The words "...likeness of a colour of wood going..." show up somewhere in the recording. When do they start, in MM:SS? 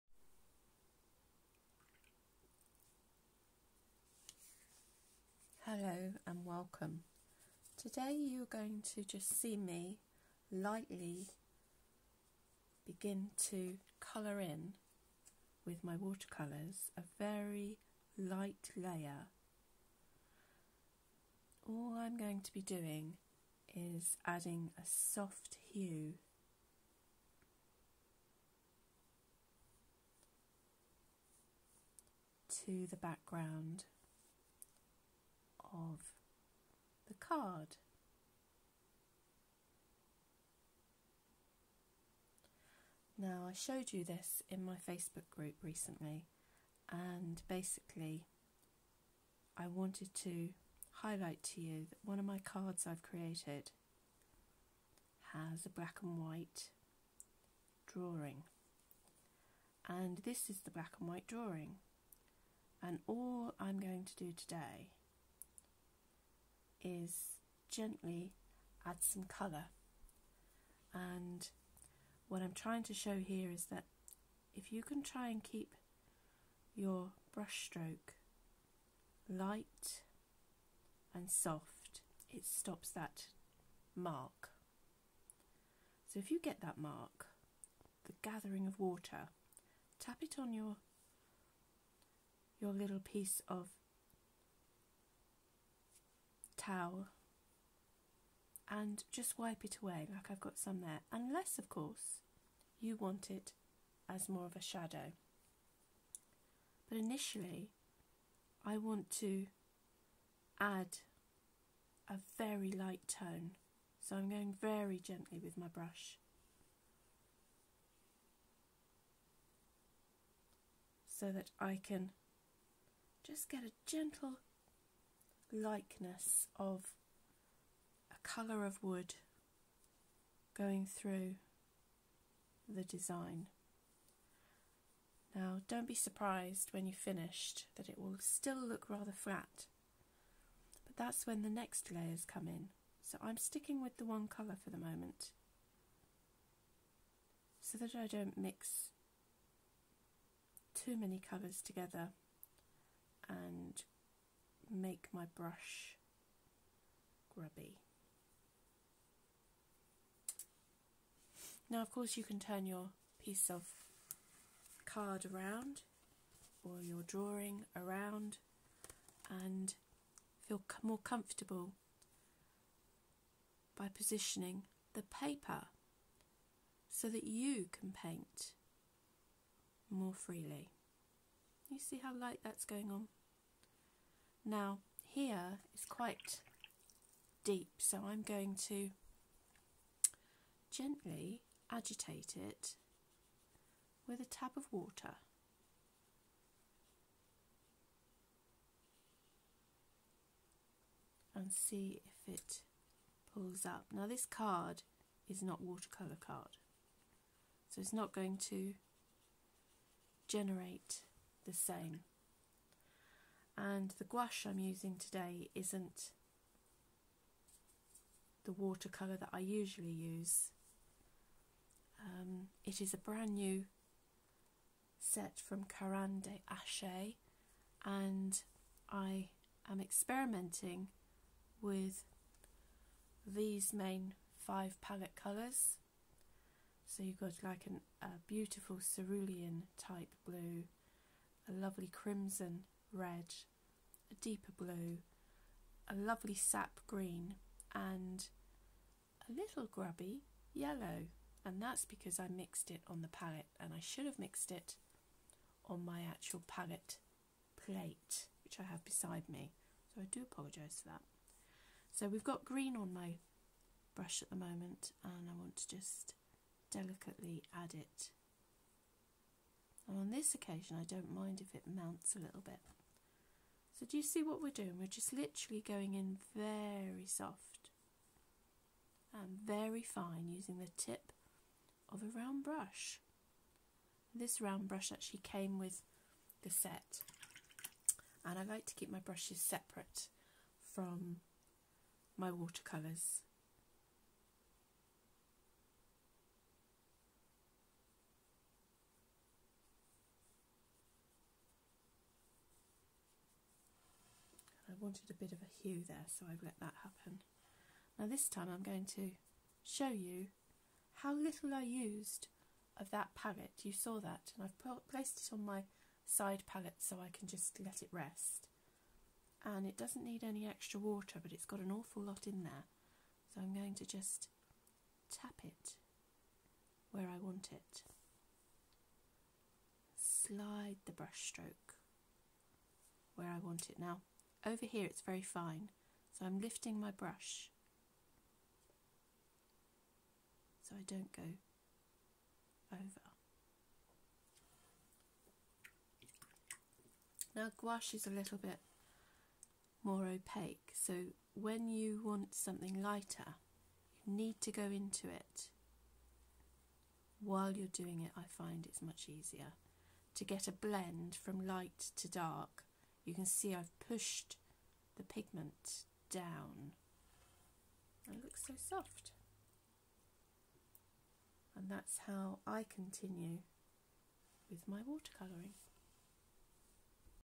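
02:05.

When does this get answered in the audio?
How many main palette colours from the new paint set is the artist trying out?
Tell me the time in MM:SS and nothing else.
03:54.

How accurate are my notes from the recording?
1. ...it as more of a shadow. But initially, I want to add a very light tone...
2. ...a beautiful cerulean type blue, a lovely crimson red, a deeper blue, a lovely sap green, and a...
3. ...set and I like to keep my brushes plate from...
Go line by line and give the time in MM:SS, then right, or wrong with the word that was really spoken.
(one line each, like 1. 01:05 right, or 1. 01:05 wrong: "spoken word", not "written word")
1. 01:43 right
2. 03:58 right
3. 04:46 wrong: "separate", not "plate".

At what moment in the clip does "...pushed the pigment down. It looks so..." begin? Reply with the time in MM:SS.
06:03.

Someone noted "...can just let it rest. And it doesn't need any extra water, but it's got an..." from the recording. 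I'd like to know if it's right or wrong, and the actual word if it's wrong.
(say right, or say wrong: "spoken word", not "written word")
right.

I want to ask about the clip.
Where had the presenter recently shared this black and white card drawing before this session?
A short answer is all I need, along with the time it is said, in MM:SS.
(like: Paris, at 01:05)
Facebook group, at 00:44.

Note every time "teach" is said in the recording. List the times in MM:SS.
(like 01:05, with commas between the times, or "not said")
not said.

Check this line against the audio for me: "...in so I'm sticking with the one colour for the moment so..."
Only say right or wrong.
right.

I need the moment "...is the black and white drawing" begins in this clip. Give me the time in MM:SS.
01:00.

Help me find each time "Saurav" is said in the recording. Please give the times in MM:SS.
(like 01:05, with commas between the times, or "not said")
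not said.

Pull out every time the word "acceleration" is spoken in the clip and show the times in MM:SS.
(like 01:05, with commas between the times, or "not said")
not said.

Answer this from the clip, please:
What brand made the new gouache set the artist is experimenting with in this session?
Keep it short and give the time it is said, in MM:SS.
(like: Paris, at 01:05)
Caran d'Ache, at 03:45.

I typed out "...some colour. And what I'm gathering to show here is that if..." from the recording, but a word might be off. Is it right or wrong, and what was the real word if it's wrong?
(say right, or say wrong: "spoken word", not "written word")
wrong: "trying", not "gathering".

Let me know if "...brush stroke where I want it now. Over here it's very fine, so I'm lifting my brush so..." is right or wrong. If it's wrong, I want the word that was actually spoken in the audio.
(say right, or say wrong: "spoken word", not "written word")
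right.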